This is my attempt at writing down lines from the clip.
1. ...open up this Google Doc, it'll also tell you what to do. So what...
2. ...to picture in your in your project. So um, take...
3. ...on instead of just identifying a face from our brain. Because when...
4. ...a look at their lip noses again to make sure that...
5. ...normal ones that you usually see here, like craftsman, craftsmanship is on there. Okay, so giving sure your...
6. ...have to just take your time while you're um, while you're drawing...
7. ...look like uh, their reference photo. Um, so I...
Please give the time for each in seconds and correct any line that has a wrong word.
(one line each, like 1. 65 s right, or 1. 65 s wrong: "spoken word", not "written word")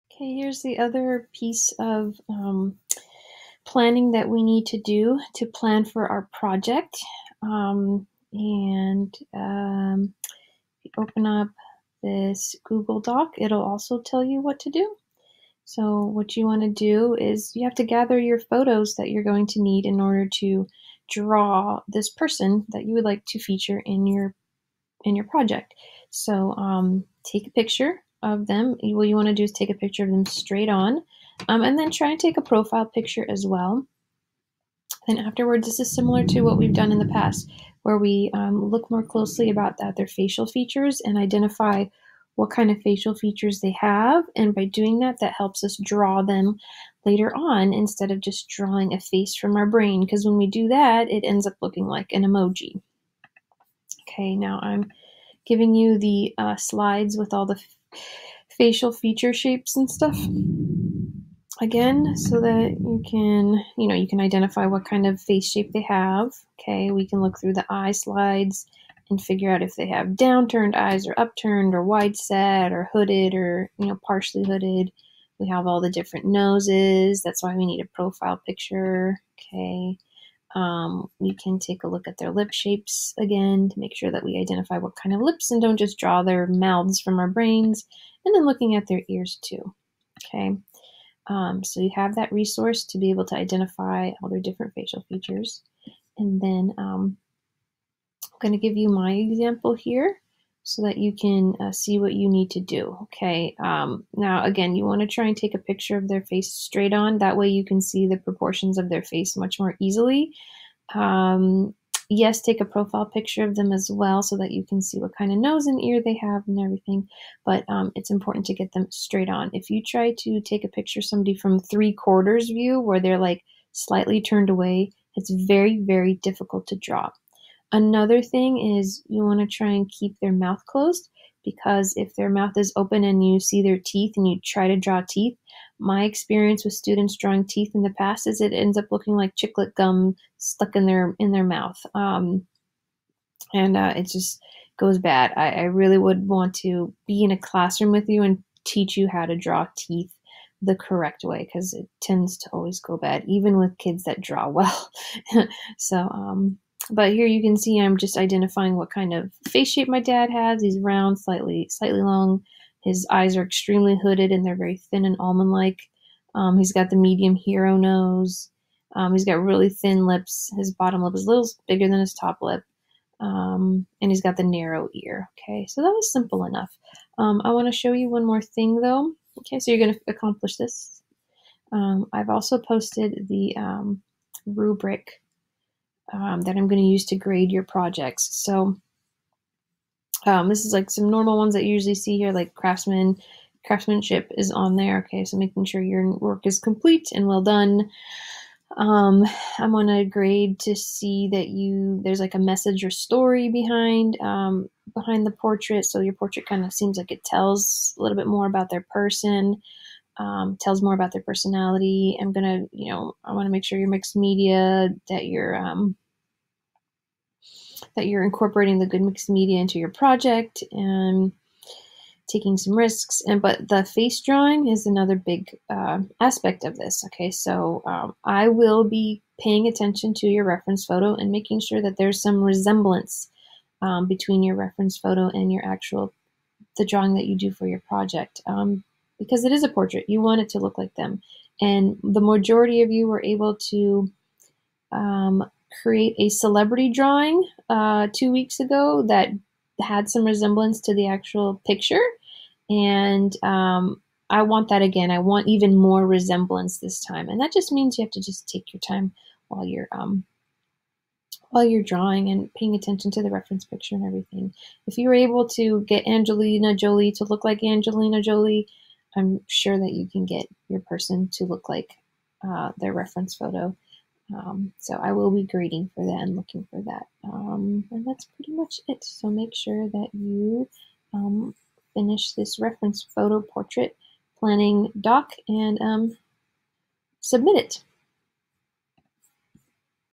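1. 10 s right
2. 23 s wrong: "feature", not "picture"
3. 47 s wrong: "drawing", not "identifying"
4. 81 s wrong: "shapes", not "noses"
5. 191 s wrong: "making", not "giving"
6. 258 s right
7. 271 s right.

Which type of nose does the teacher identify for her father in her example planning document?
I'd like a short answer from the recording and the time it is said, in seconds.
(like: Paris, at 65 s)
Medium hero nose, at 166 s.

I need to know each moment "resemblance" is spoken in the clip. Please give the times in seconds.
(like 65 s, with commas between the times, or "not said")
232 s, 250 s, 256 s.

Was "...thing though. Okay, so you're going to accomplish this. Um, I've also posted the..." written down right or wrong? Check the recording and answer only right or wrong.
right.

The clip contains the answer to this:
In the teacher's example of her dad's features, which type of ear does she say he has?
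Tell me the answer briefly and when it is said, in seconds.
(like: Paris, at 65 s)
Narrow ear, at 174 s.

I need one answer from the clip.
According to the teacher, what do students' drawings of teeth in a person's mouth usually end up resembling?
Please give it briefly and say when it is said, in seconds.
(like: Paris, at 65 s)
Chiclet gum, at 139 s.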